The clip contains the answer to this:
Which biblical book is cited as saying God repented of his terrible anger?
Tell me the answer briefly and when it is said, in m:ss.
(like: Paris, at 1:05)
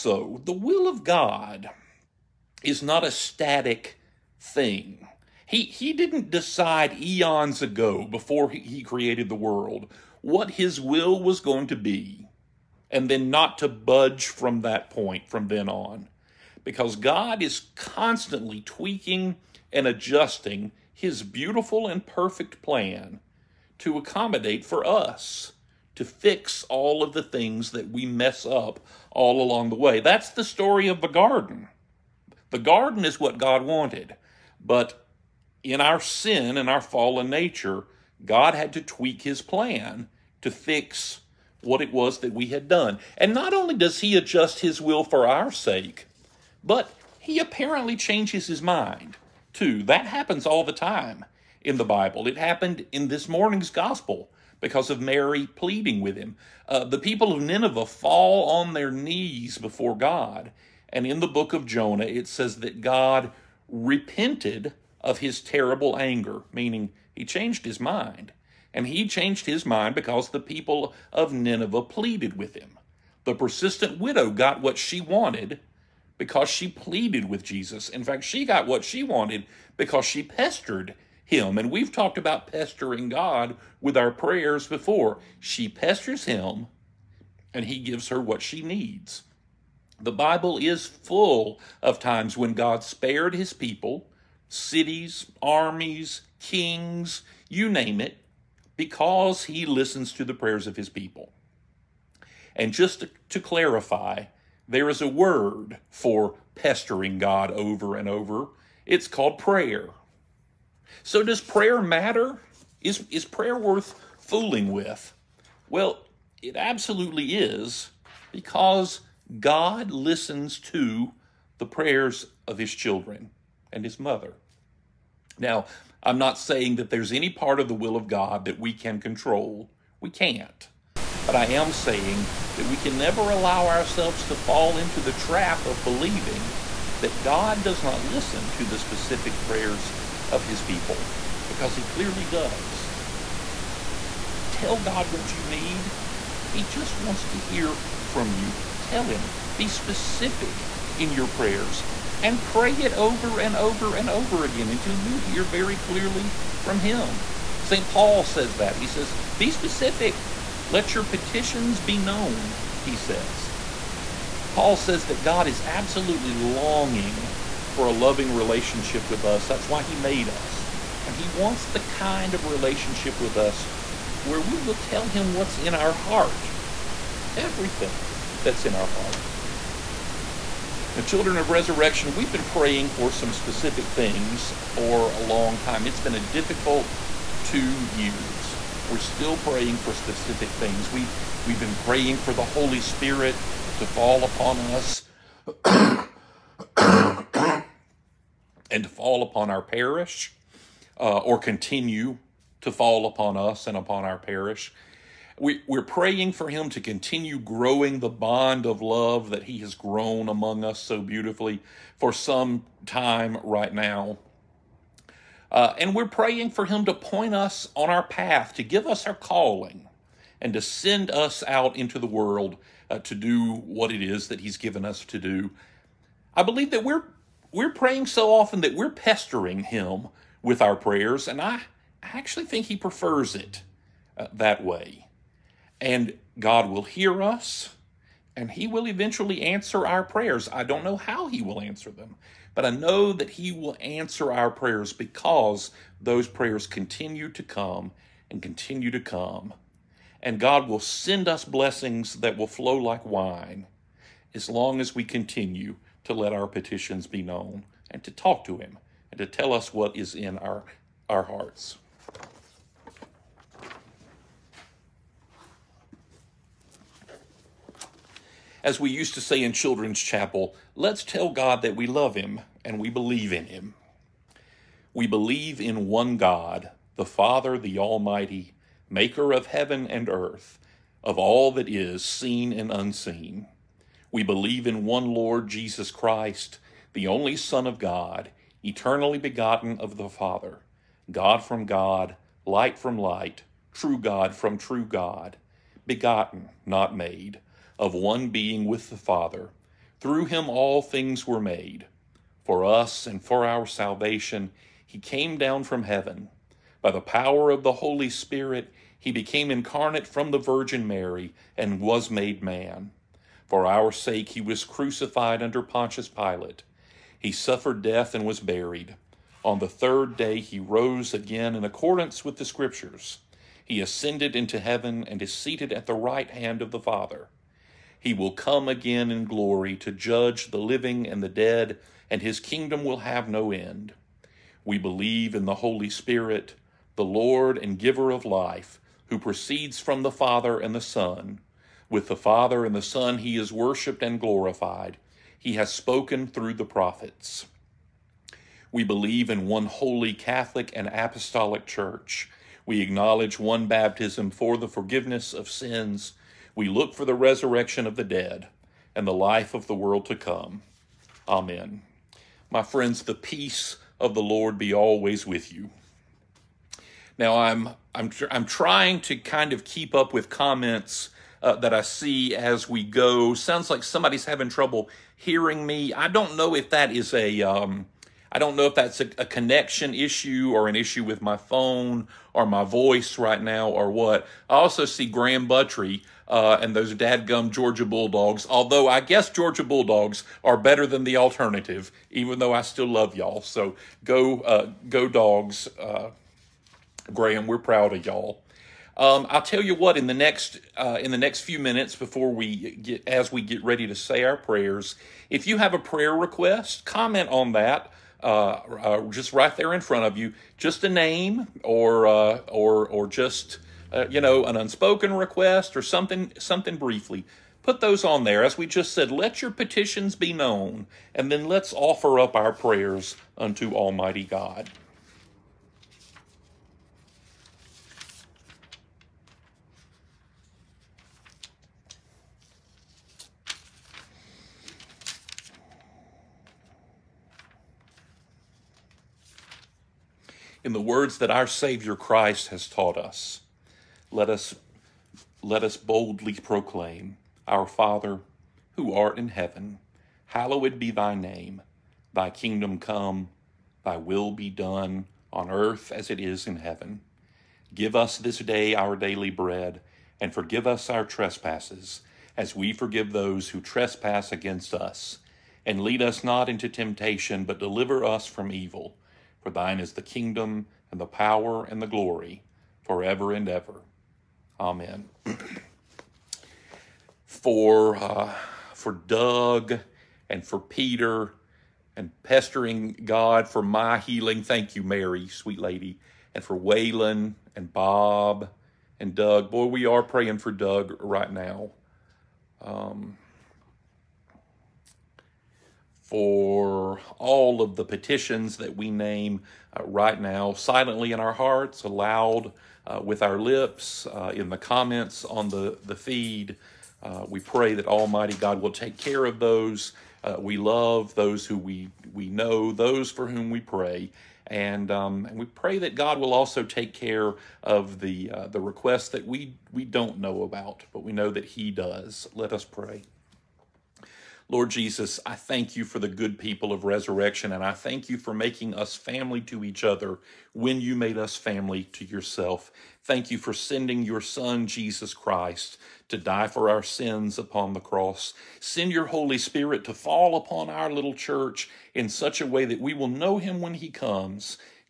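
Jonah, at 1:01.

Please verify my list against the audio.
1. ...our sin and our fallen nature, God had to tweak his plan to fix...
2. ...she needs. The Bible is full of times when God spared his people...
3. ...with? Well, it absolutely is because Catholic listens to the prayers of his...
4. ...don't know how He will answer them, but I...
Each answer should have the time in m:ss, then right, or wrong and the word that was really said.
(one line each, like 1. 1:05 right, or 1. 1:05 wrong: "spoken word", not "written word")
1. 0:35 right
2. 1:28 right
3. 1:54 wrong: "God", not "Catholic"
4. 4:00 right.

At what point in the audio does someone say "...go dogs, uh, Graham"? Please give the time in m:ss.
6:34.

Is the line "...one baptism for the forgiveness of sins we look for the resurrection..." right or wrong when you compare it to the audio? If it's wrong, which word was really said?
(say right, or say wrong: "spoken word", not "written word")
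right.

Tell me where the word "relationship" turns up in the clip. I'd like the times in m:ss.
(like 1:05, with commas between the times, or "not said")
2:48, 2:52.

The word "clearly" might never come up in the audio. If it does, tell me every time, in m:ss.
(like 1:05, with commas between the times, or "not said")
2:21, 2:35.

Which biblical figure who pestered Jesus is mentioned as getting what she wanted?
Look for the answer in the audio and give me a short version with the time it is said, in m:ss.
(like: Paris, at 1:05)
The persistent widow, at 1:13.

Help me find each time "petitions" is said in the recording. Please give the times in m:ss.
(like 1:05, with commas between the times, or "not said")
2:41, 4:16, 6:59, 8:17.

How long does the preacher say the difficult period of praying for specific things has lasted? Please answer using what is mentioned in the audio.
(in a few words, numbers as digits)
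2 years.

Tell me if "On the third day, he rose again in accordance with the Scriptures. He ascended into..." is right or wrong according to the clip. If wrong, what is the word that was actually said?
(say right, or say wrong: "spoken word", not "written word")
right.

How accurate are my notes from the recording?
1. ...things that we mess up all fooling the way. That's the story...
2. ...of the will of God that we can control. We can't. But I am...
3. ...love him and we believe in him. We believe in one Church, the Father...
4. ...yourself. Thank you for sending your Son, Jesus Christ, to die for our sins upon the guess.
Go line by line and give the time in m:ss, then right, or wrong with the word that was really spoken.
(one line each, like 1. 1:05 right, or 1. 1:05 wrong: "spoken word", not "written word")
1. 0:27 wrong: "along", not "fooling"
2. 2:07 right
3. 4:31 wrong: "God", not "Church"
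4. 8:52 wrong: "cross", not "guess".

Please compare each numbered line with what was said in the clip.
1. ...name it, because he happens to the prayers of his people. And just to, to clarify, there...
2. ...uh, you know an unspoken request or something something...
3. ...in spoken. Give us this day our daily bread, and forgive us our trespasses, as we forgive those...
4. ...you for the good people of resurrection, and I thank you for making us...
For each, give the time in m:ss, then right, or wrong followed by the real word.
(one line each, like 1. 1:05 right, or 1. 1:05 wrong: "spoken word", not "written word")
1. 1:37 wrong: "listens", not "happens"
2. 6:53 right
3. 7:36 wrong: "heaven", not "spoken"
4. 8:45 right.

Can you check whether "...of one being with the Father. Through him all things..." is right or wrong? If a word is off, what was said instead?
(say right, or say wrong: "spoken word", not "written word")
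right.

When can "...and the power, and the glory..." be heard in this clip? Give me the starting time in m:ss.
7:50.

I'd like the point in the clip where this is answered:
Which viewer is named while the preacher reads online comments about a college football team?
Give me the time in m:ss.
6:25.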